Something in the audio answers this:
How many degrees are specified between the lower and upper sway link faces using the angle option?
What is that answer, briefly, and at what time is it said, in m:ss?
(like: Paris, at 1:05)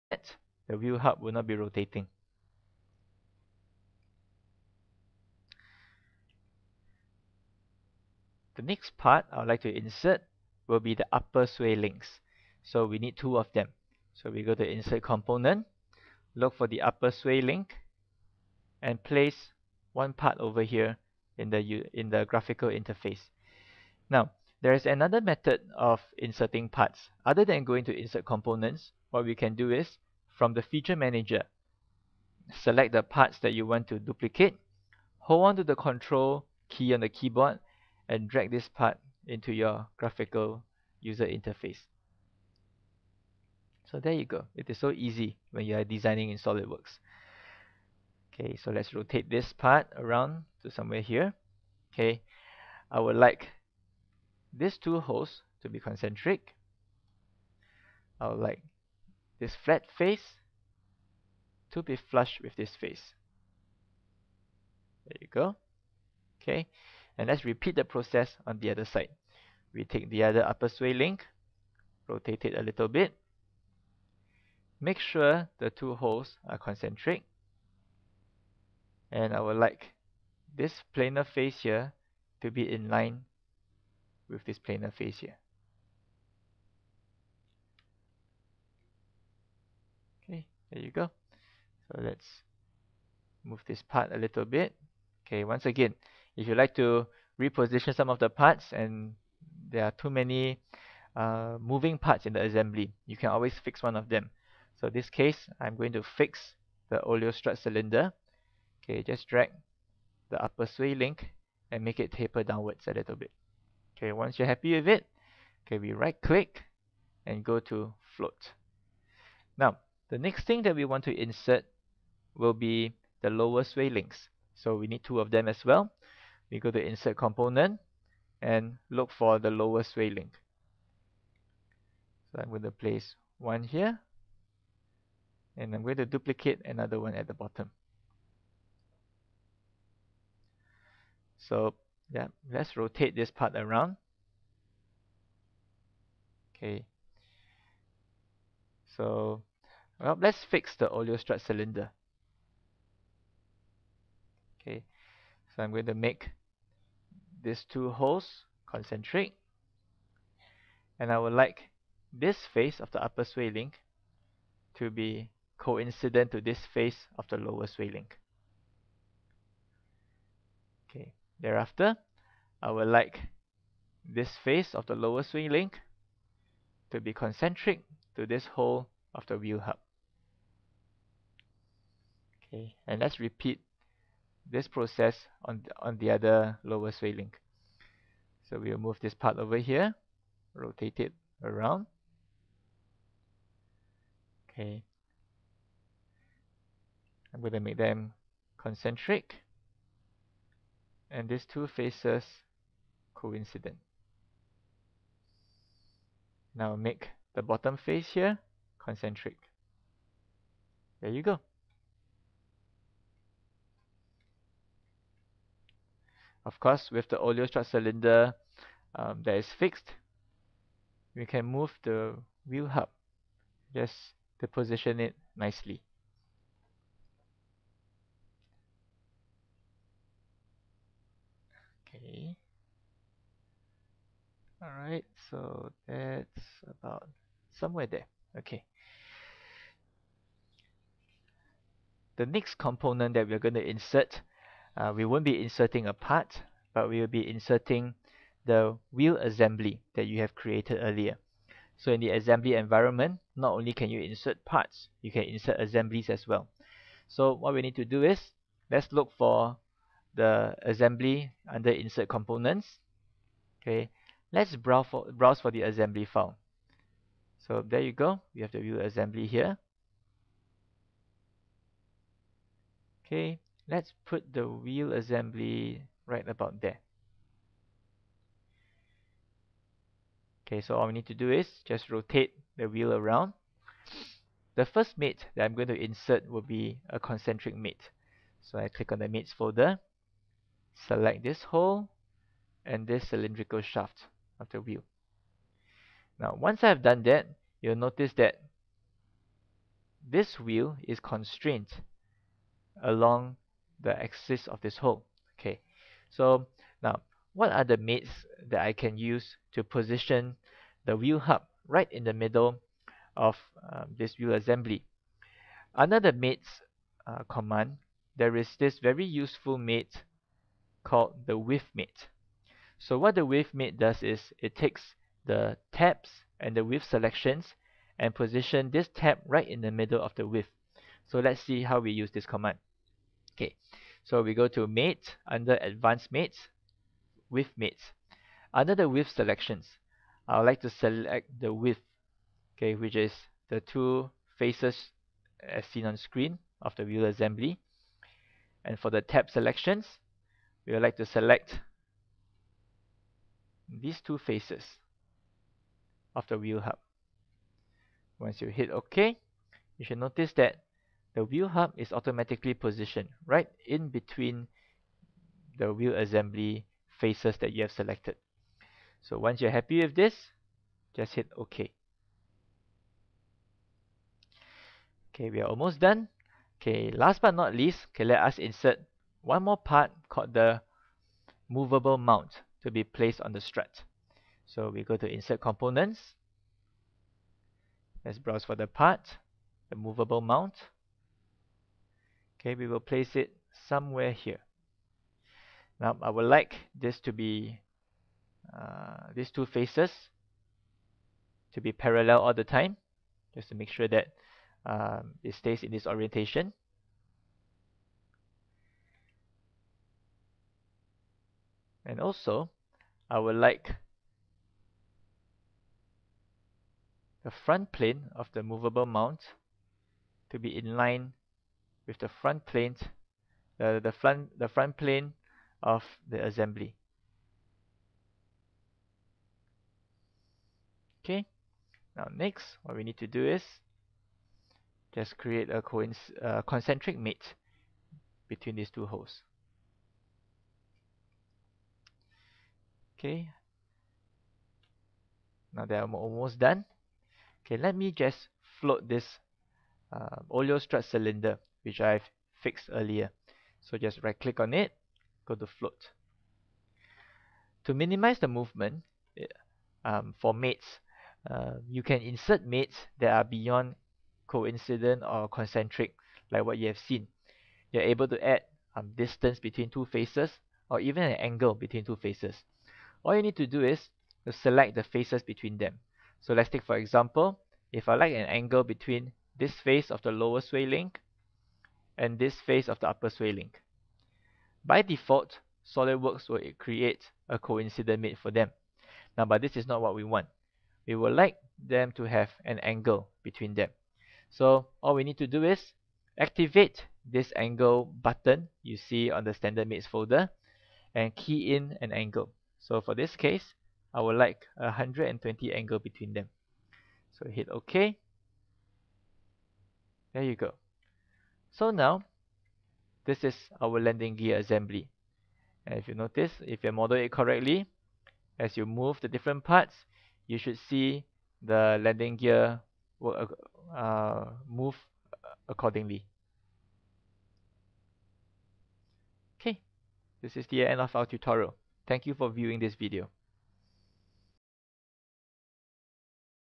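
120, at 8:24.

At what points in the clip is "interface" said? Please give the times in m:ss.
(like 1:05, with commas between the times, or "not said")
0:22, 0:41.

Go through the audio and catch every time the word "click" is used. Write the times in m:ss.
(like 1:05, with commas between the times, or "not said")
1:56, 4:48, 7:34.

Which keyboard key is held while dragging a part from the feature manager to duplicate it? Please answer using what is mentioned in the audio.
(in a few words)
Control key.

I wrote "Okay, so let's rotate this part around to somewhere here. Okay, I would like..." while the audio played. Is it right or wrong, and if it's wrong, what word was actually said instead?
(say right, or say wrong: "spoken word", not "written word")
right.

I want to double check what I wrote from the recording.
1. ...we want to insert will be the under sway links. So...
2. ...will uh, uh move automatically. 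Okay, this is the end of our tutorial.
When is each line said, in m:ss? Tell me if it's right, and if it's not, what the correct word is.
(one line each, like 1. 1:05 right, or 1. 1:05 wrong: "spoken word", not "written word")
1. 2:00 wrong: "lower", not "under"
2. 8:42 wrong: "accordingly", not "automatically".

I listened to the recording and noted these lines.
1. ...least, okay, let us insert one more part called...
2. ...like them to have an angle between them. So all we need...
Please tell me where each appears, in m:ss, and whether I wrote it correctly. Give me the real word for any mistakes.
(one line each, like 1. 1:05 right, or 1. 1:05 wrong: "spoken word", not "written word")
1. 6:17 right
2. 8:11 right.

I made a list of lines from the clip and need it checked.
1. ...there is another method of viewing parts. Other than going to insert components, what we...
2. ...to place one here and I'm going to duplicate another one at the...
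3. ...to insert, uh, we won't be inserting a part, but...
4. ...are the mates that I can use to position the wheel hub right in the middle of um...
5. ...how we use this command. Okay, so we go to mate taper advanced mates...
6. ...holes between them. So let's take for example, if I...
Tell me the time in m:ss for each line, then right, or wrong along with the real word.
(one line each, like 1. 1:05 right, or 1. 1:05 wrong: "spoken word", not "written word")
1. 0:24 wrong: "inserting", not "viewing"
2. 2:12 right
3. 4:03 right
4. 5:07 right
5. 5:31 wrong: "under", not "taper"
6. 7:54 wrong: "faces", not "holes".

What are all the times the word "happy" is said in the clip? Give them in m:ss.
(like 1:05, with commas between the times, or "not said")
1:54, 6:09.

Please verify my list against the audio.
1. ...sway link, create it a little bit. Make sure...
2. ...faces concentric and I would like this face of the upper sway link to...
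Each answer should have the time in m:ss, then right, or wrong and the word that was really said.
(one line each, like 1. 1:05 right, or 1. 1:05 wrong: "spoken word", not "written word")
1. 1:10 wrong: "rotate", not "create"
2. 2:37 wrong: "holes", not "faces".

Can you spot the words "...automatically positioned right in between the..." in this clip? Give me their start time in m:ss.
6:01.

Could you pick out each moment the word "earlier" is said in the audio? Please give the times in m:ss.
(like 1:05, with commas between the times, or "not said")
4:10, 7:32.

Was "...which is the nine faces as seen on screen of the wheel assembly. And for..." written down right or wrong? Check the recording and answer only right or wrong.
wrong.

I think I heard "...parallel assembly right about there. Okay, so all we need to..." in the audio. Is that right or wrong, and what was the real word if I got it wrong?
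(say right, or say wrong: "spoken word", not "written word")
wrong: "wheel", not "parallel".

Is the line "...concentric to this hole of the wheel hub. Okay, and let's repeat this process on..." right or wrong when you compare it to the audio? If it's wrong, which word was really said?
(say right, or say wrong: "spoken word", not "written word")
right.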